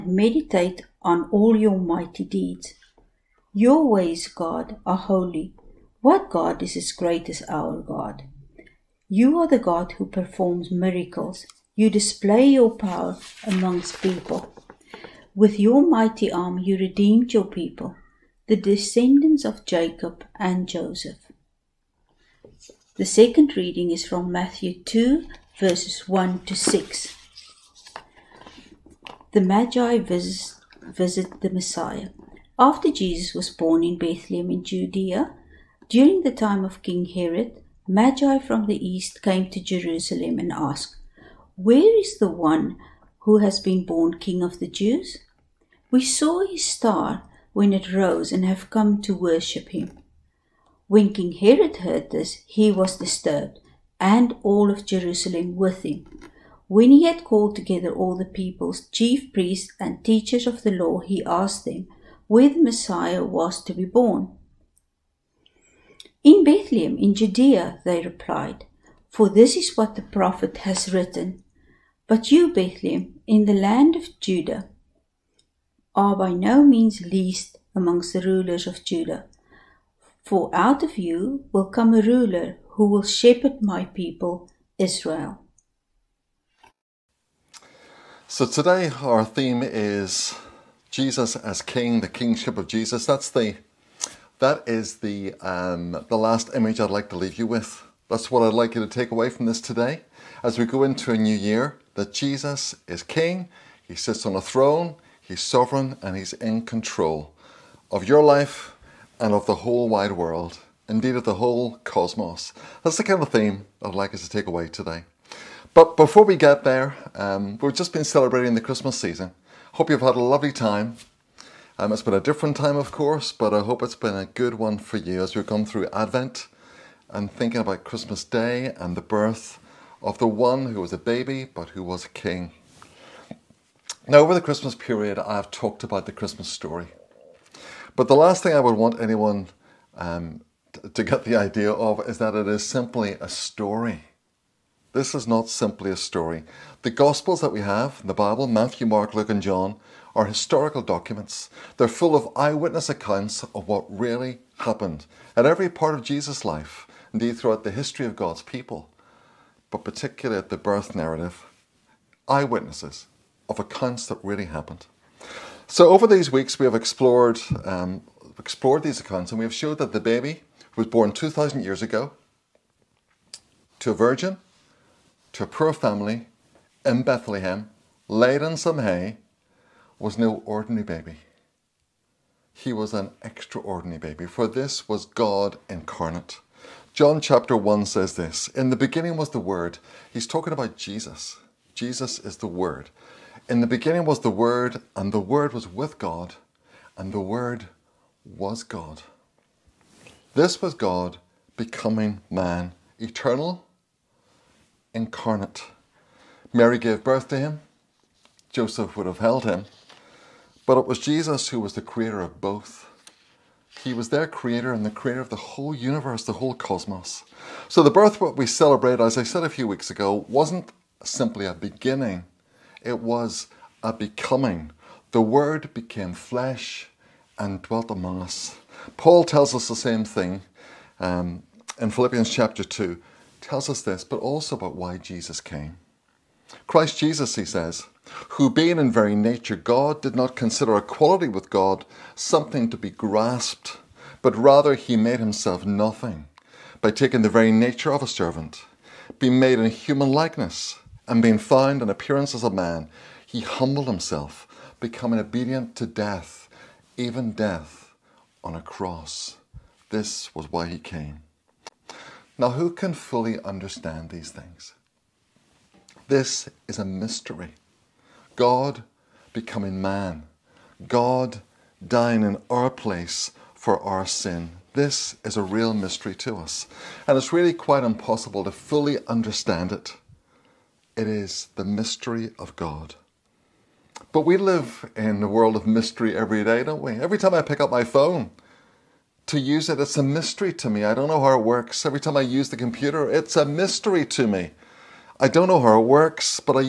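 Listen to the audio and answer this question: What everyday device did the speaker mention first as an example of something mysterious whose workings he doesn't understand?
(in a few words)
phone.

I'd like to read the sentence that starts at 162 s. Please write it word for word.
Eyewitnesses of accounts that really happened.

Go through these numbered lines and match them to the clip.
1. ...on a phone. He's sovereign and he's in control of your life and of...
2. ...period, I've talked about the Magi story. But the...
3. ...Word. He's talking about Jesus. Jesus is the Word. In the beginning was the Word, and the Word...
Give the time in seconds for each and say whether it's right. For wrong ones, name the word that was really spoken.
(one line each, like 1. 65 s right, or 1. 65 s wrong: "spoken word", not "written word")
1. 104 s wrong: "throne", not "phone"
2. 134 s wrong: "Christmas", not "Magi"
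3. 189 s right.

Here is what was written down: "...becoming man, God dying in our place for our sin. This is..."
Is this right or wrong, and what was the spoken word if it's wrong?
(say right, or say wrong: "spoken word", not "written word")
right.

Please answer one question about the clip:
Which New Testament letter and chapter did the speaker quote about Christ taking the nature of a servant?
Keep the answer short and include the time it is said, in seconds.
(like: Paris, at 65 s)
Philippians chapter 2, at 231 s.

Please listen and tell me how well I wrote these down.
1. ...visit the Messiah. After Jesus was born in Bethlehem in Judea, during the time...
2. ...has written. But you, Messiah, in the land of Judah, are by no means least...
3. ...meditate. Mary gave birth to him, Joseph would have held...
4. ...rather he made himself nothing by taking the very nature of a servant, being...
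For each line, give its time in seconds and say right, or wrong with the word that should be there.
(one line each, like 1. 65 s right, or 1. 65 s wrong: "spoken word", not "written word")
1. 30 s right
2. 70 s wrong: "Bethlehem", not "Messiah"
3. 204 s wrong: "incarnate", not "meditate"
4. 244 s right.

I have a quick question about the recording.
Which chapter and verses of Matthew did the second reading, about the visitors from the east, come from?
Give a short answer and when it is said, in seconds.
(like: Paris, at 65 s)
Matthew 2, verses 1 to 6, at 24 s.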